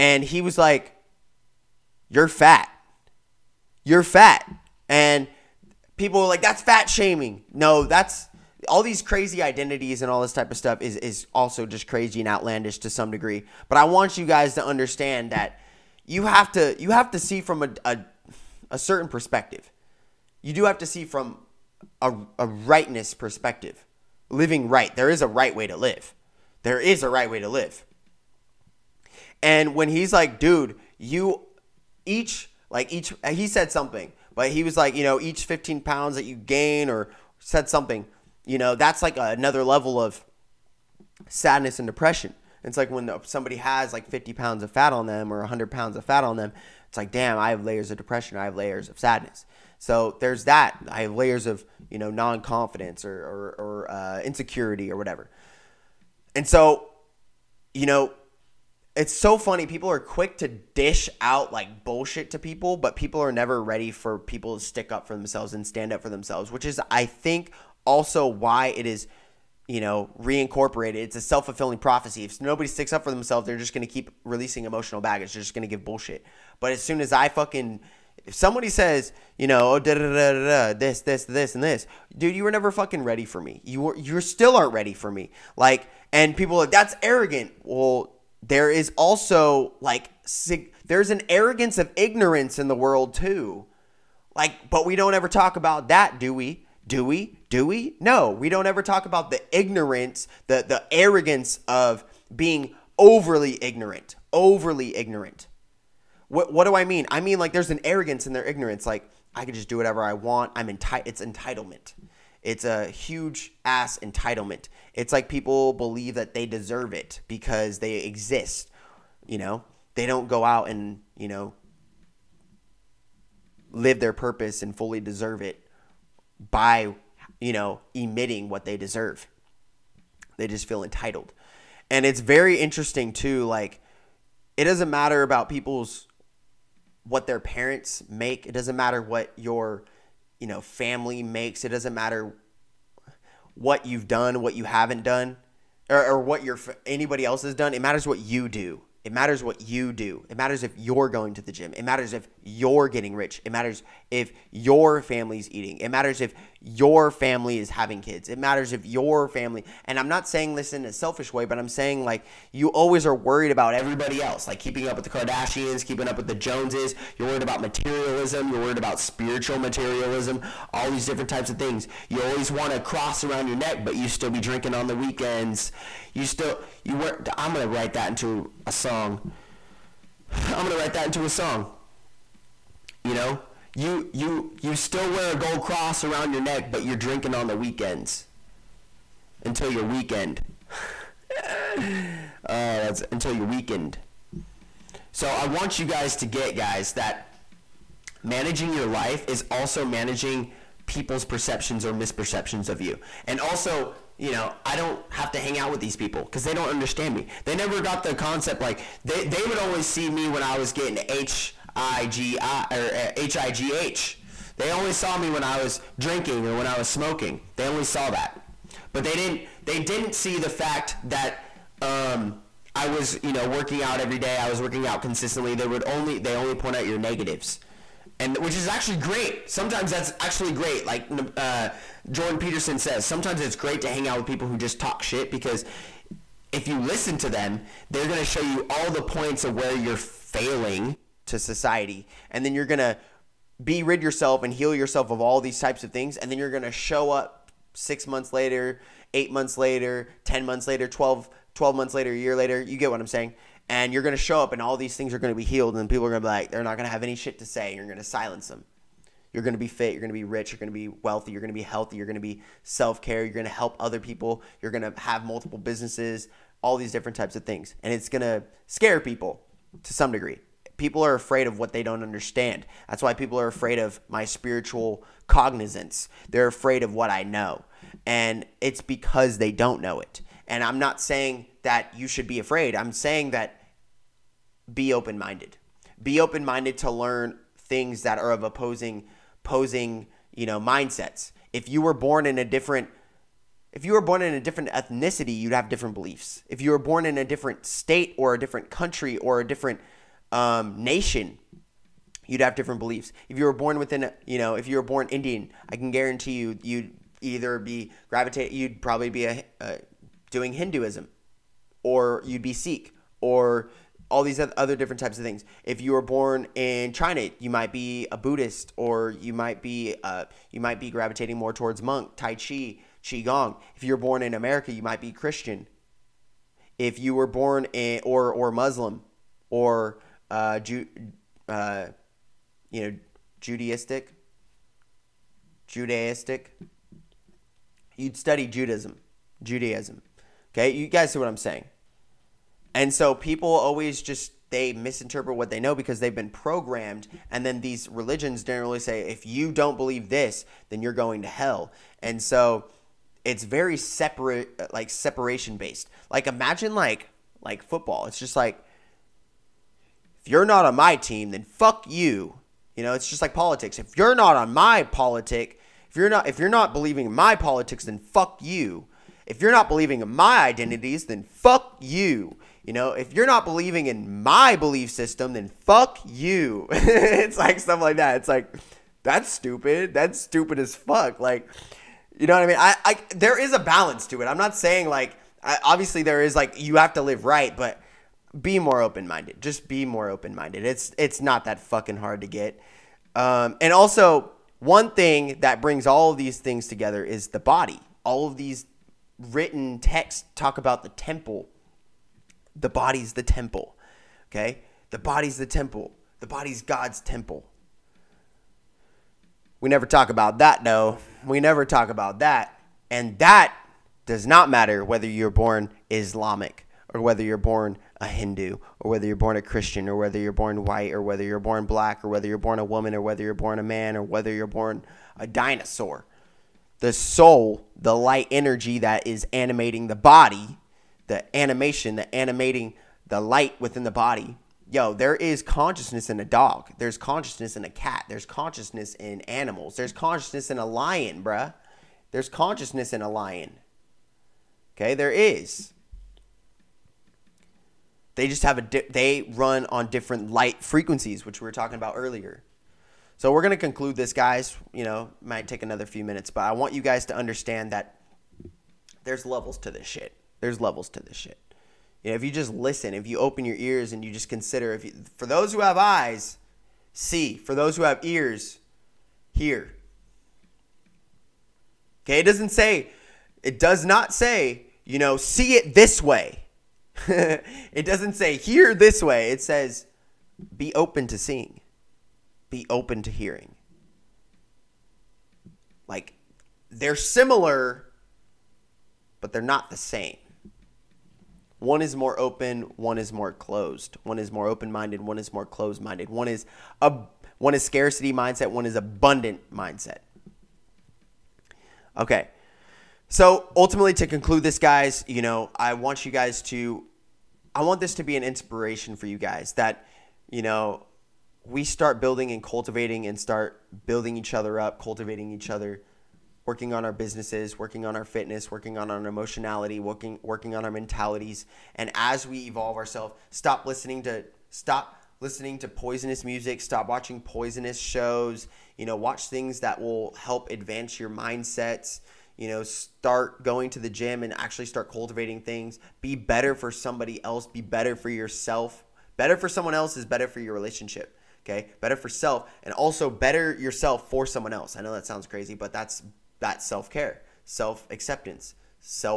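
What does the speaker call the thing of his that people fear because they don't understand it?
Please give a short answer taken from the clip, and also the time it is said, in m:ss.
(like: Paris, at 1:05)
Spiritual cognizance, at 4:34.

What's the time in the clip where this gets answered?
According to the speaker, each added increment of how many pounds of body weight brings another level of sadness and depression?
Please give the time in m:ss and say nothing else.
0:35.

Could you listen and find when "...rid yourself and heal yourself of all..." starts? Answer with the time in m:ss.
4:03.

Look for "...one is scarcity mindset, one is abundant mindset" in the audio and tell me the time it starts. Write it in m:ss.
8:17.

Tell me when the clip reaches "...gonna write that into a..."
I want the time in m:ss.
3:00.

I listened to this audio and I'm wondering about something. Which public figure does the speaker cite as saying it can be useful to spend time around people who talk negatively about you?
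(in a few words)
Jordan Peterson.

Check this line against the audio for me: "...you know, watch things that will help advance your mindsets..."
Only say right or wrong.
right.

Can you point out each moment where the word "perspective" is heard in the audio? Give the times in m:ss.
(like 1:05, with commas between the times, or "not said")
0:19, 0:23.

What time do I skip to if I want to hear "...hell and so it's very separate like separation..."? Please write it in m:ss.
5:51.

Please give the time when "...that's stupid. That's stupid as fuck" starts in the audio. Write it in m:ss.
6:19.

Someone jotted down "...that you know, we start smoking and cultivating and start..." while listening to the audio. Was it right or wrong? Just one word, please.
wrong.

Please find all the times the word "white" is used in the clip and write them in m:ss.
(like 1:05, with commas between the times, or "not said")
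7:00.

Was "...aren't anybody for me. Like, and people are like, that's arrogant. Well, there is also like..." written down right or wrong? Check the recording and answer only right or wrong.
wrong.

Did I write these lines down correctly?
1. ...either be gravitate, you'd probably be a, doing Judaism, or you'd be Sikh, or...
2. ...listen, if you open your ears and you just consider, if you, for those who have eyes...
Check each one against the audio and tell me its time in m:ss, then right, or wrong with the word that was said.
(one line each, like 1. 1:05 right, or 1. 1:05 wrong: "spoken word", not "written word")
1. 5:07 wrong: "Hinduism", not "Judaism"
2. 7:42 right.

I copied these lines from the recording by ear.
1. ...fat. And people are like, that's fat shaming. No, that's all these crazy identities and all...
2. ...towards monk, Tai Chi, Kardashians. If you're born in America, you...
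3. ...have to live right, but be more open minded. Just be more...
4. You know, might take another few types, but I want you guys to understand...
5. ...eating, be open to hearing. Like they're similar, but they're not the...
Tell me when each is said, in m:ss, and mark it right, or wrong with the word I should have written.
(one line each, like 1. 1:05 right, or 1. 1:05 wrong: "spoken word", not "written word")
1. 0:04 right
2. 5:21 wrong: "Qigong", not "Kardashians"
3. 6:26 right
4. 7:34 wrong: "minutes", not "types"
5. 8:01 wrong: "seeing", not "eating".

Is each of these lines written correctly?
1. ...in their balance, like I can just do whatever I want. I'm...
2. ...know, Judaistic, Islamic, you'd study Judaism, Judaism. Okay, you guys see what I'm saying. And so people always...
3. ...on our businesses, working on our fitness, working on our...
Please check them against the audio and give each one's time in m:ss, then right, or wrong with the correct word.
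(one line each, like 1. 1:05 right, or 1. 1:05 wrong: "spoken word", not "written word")
1. 1:48 wrong: "ignorance", not "balance"
2. 5:32 wrong: "Judaistic", not "Islamic"
3. 8:36 right.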